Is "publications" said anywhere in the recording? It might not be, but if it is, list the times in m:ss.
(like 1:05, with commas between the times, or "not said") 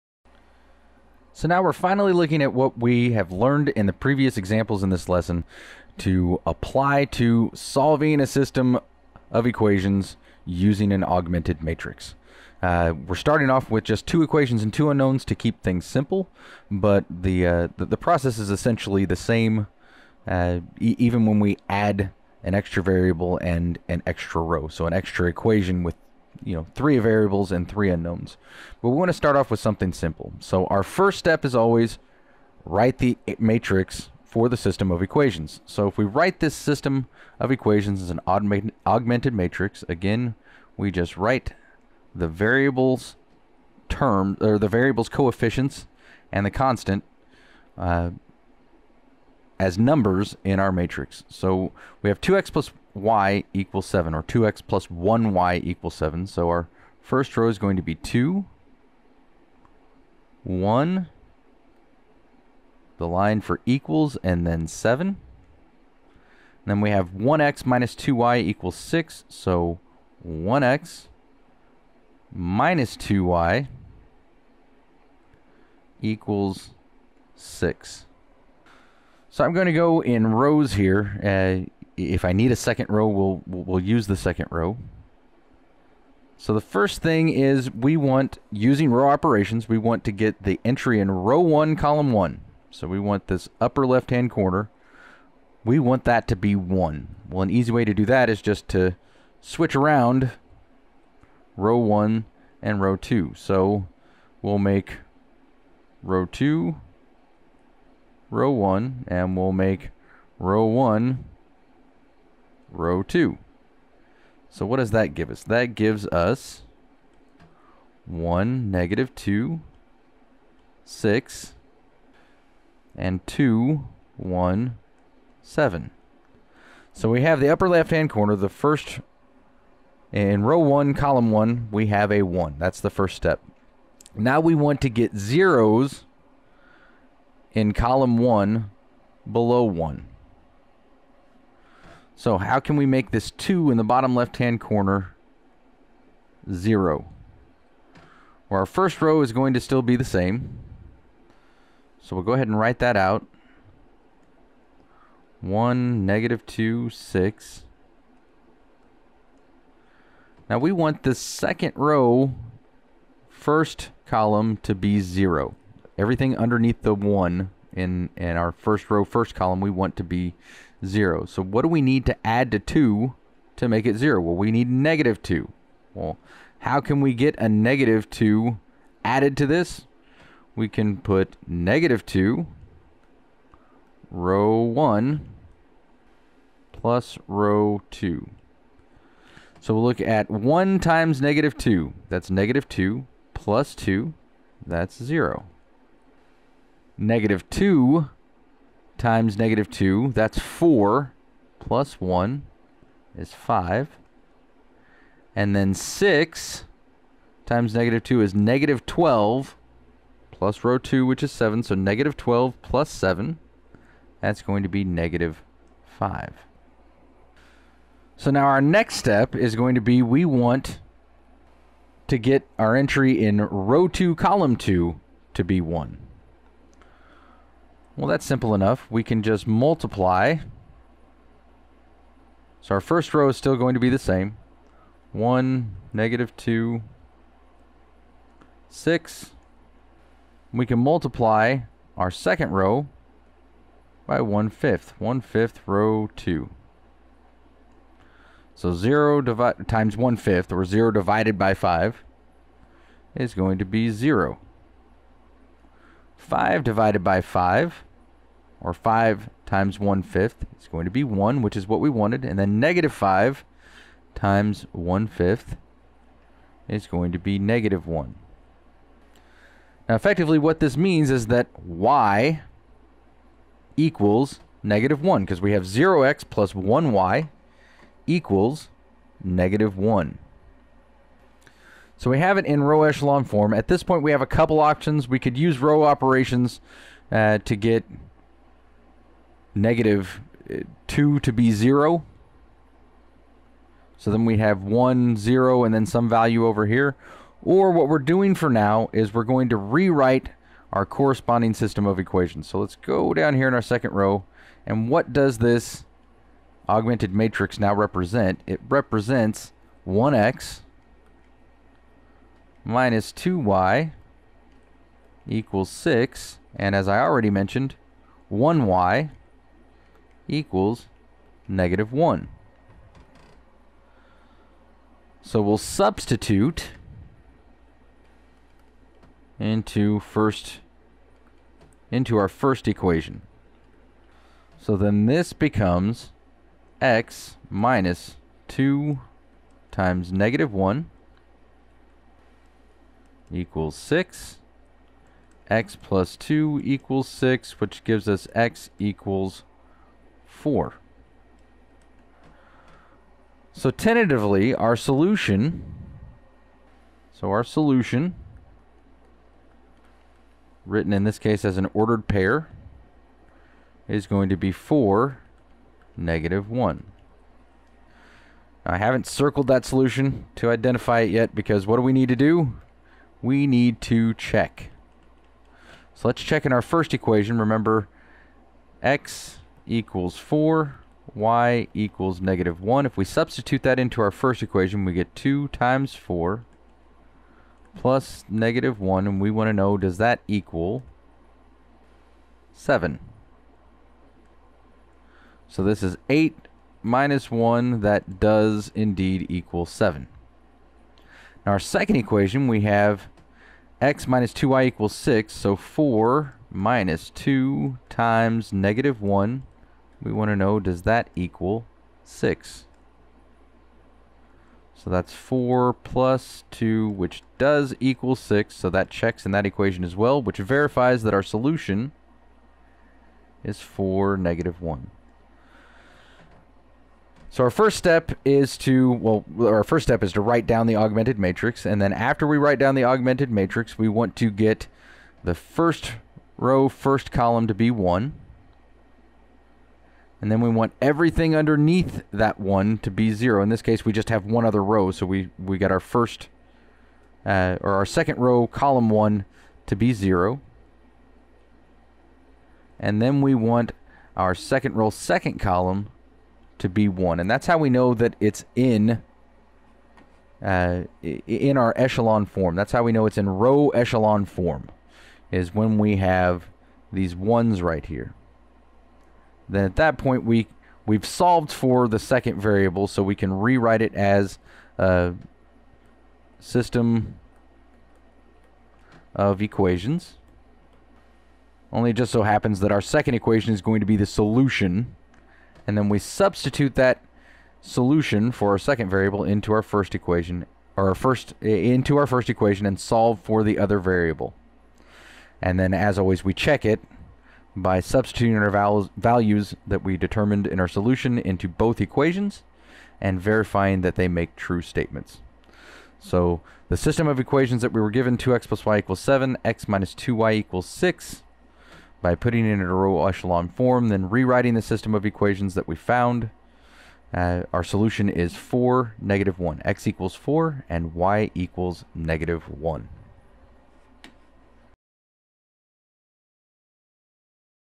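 not said.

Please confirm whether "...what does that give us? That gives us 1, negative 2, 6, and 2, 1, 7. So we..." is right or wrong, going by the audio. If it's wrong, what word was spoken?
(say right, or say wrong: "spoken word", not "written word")
right.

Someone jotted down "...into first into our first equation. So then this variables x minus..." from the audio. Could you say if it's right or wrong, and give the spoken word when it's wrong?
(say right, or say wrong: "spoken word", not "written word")
wrong: "becomes", not "variables".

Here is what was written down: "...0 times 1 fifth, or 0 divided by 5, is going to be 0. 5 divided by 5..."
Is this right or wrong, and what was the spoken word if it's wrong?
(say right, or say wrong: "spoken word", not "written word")
right.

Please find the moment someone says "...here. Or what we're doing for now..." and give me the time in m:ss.
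4:56.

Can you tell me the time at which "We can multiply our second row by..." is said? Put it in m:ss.
4:00.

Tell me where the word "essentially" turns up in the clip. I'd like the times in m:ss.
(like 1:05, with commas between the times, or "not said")
0:18.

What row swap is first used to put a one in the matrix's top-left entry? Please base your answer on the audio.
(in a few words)
switch row 1 and row 2.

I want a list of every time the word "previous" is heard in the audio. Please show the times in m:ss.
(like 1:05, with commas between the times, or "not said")
0:03.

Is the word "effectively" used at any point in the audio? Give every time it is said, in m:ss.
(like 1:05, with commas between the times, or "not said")
4:29.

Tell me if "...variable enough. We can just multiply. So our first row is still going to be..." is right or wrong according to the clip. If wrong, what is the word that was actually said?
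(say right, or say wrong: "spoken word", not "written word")
wrong: "simple", not "variable".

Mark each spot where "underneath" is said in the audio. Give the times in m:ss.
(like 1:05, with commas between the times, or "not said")
2:46, 7:21.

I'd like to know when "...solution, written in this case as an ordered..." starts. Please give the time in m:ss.
5:57.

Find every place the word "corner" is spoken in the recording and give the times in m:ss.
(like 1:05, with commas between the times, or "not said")
1:34, 2:08, 2:24.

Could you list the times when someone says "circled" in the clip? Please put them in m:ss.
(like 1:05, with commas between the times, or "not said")
6:09.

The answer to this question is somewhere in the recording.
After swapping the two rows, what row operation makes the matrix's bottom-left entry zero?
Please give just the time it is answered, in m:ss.
3:01.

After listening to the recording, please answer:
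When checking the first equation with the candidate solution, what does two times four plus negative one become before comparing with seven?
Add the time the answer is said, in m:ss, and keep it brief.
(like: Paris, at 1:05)
8 minus 1, at 6:36.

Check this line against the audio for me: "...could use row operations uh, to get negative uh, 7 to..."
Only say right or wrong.
wrong.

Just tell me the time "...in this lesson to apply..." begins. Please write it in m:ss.
0:04.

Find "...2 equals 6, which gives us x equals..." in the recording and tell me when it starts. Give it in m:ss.
5:46.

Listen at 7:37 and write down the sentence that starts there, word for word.
And that's how we know that it's in uh, in our echelon form.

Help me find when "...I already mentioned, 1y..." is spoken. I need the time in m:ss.
5:16.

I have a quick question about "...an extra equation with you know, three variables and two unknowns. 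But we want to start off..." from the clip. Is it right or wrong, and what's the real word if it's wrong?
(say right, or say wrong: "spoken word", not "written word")
wrong: "three", not "two".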